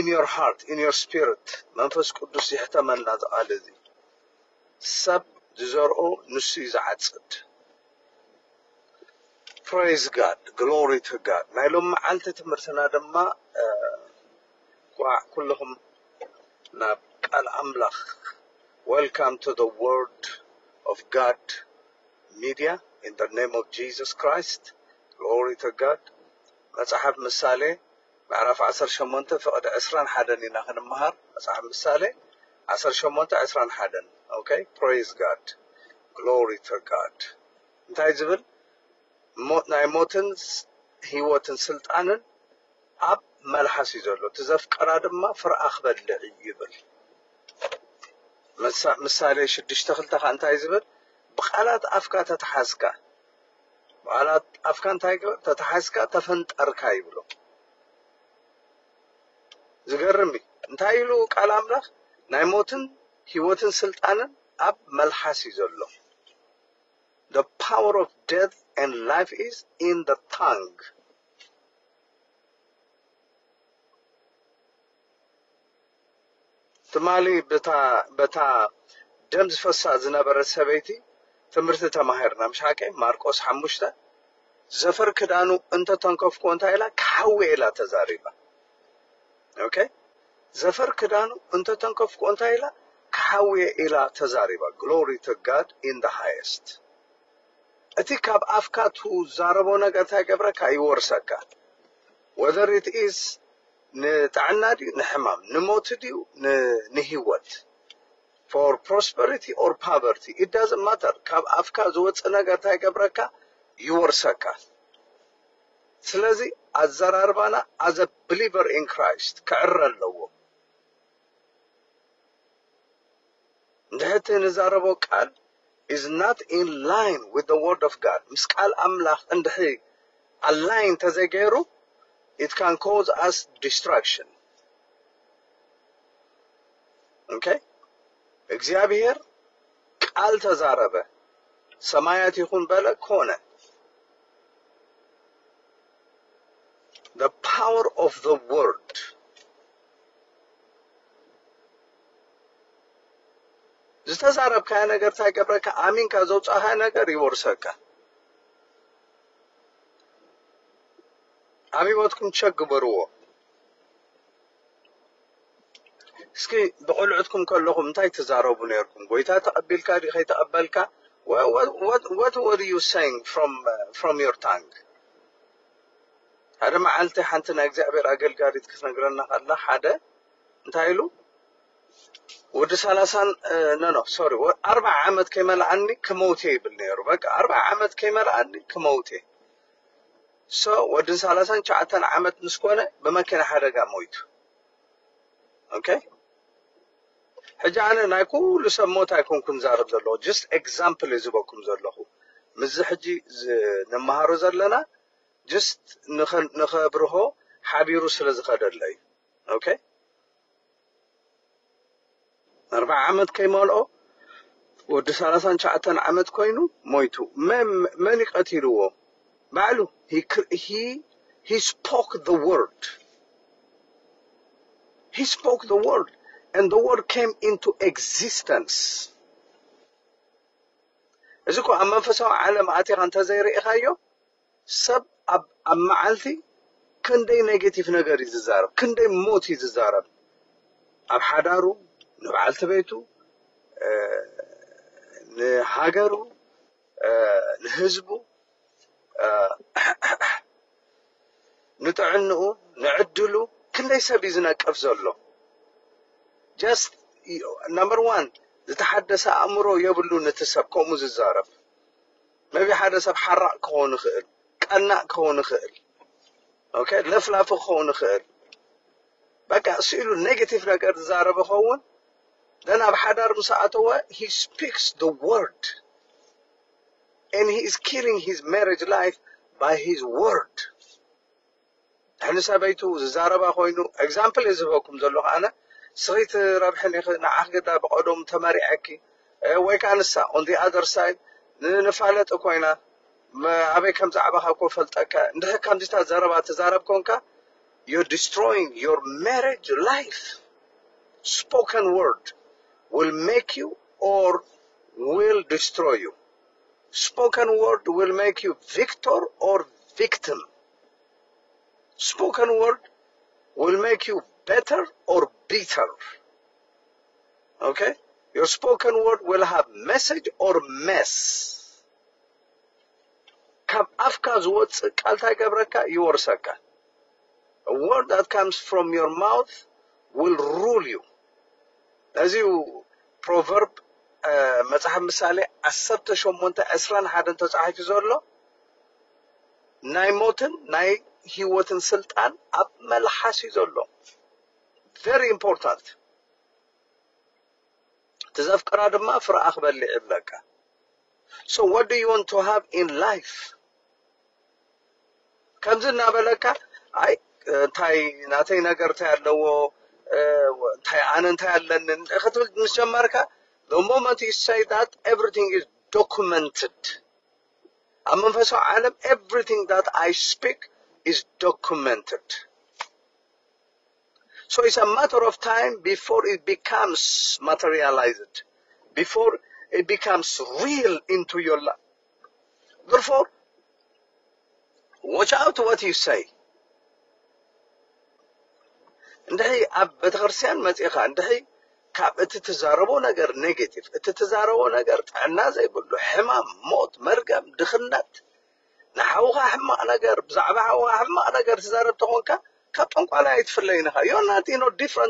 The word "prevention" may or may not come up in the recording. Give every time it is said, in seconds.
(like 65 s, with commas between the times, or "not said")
not said.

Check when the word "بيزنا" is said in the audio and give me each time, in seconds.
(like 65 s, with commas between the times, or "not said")
254 s.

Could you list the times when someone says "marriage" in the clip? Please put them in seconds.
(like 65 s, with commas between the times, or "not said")
278 s, 299 s.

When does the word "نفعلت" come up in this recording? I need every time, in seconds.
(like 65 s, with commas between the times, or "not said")
291 s.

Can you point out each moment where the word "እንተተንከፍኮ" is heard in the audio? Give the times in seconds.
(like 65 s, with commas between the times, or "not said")
85 s, 91 s.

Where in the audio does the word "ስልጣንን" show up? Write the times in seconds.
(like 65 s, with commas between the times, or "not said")
41 s, 63 s.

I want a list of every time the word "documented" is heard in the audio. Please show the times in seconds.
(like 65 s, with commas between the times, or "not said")
365 s, 371 s.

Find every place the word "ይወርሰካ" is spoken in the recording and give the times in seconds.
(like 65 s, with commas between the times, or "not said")
100 s, 113 s, 157 s.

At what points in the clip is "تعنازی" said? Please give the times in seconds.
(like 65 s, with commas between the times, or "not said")
395 s.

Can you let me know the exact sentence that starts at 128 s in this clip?
ምስ ቃል ኣምላኽ እንድሕሪ ኣላይን it can cause us destruction.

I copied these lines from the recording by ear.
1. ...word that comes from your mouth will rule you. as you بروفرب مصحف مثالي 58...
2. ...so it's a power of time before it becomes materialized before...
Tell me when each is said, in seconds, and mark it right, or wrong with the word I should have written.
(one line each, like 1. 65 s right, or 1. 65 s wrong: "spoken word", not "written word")
1. 327 s wrong: "18", not "58"
2. 374 s wrong: "matter", not "power".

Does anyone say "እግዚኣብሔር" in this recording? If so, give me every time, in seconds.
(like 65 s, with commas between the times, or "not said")
138 s, 177 s.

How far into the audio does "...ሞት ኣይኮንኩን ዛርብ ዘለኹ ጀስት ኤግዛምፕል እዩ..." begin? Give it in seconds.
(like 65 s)
198 s.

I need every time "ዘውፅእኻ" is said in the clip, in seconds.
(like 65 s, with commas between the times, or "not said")
156 s.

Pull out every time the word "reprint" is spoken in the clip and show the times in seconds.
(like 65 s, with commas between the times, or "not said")
not said.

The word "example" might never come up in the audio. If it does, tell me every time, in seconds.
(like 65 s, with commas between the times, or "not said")
283 s.